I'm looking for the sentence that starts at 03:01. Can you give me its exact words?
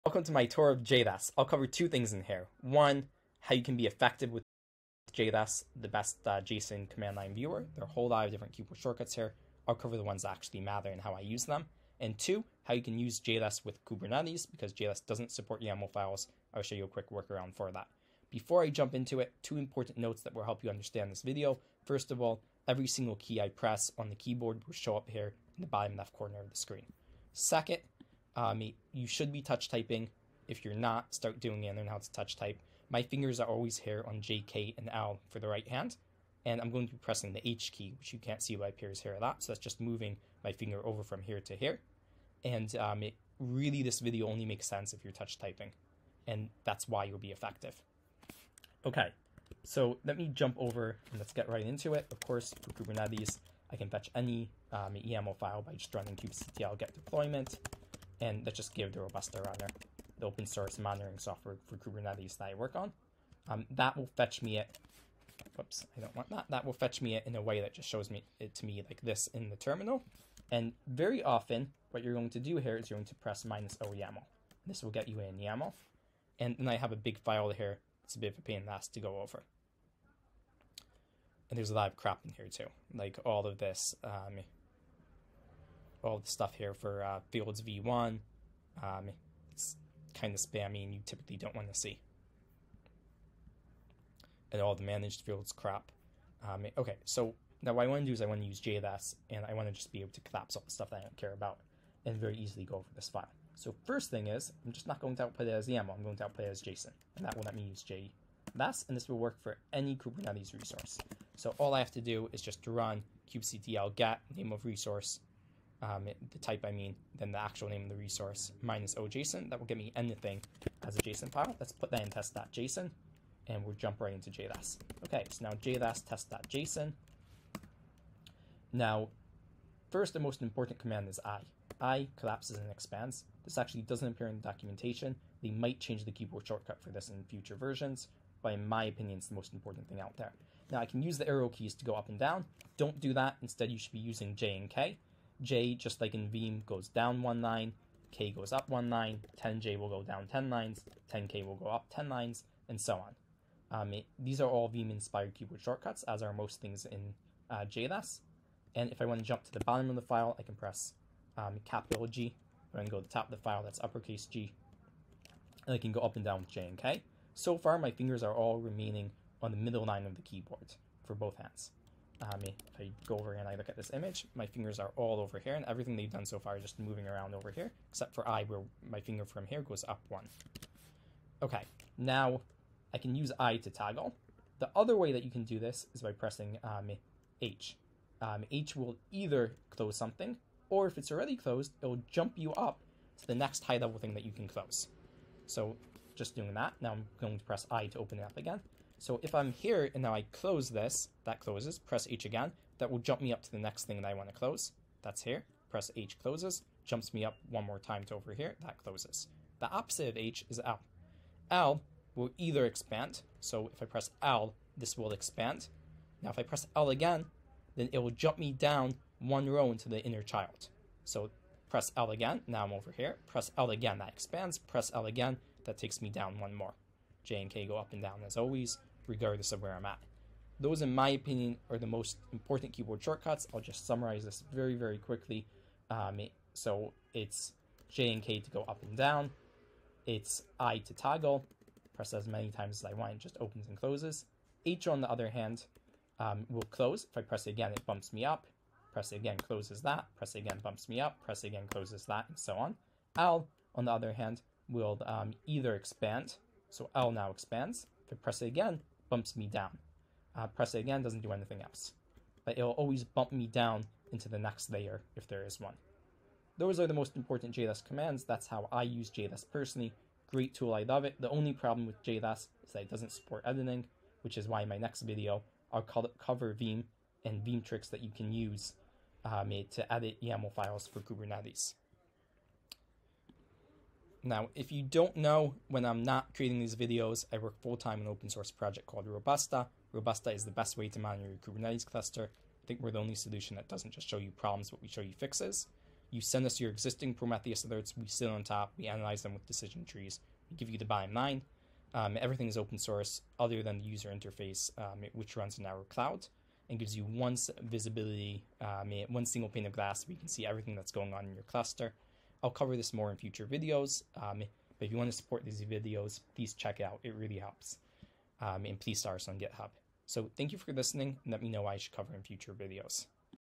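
Okay, now I can use I to toggle.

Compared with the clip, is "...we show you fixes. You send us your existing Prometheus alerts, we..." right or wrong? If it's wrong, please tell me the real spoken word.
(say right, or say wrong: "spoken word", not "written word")
right.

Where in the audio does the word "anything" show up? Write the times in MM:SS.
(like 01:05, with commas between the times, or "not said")
01:59, 04:21.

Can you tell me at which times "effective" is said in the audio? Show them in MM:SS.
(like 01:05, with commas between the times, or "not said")
00:03, 00:47.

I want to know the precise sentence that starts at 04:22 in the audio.
But it'll always bump me down into the next layer if there is one.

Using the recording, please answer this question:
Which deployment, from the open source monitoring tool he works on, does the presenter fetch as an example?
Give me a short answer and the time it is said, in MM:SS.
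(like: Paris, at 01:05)
Robusta runner, at 00:59.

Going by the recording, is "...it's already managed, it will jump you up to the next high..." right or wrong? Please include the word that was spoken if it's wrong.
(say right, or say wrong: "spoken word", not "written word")
wrong: "closed", not "managed".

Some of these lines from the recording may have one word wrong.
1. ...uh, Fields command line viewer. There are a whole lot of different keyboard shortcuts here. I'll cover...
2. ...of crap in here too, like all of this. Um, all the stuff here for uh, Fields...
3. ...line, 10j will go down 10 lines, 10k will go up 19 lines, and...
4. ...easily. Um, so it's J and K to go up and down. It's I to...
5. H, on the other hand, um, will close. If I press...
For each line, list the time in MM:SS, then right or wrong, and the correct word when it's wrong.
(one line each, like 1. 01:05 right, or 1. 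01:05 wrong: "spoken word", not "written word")
1. 00:06 wrong: "JSON", not "Fields"
2. 01:21 right
3. 02:28 wrong: "10", not "19"
4. 03:54 wrong: "quickly", not "easily"
5. 04:04 right.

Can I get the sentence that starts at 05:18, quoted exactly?
Um, and please star us on GitHub.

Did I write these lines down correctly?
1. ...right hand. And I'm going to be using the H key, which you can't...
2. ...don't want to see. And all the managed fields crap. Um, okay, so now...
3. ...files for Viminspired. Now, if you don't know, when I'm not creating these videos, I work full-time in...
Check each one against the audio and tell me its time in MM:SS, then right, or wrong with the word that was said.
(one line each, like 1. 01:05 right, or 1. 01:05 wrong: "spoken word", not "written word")
1. 00:35 wrong: "pressing", not "using"
2. 01:31 right
3. 04:40 wrong: "Kubernetes", not "Viminspired".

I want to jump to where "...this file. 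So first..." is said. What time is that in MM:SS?
01:42.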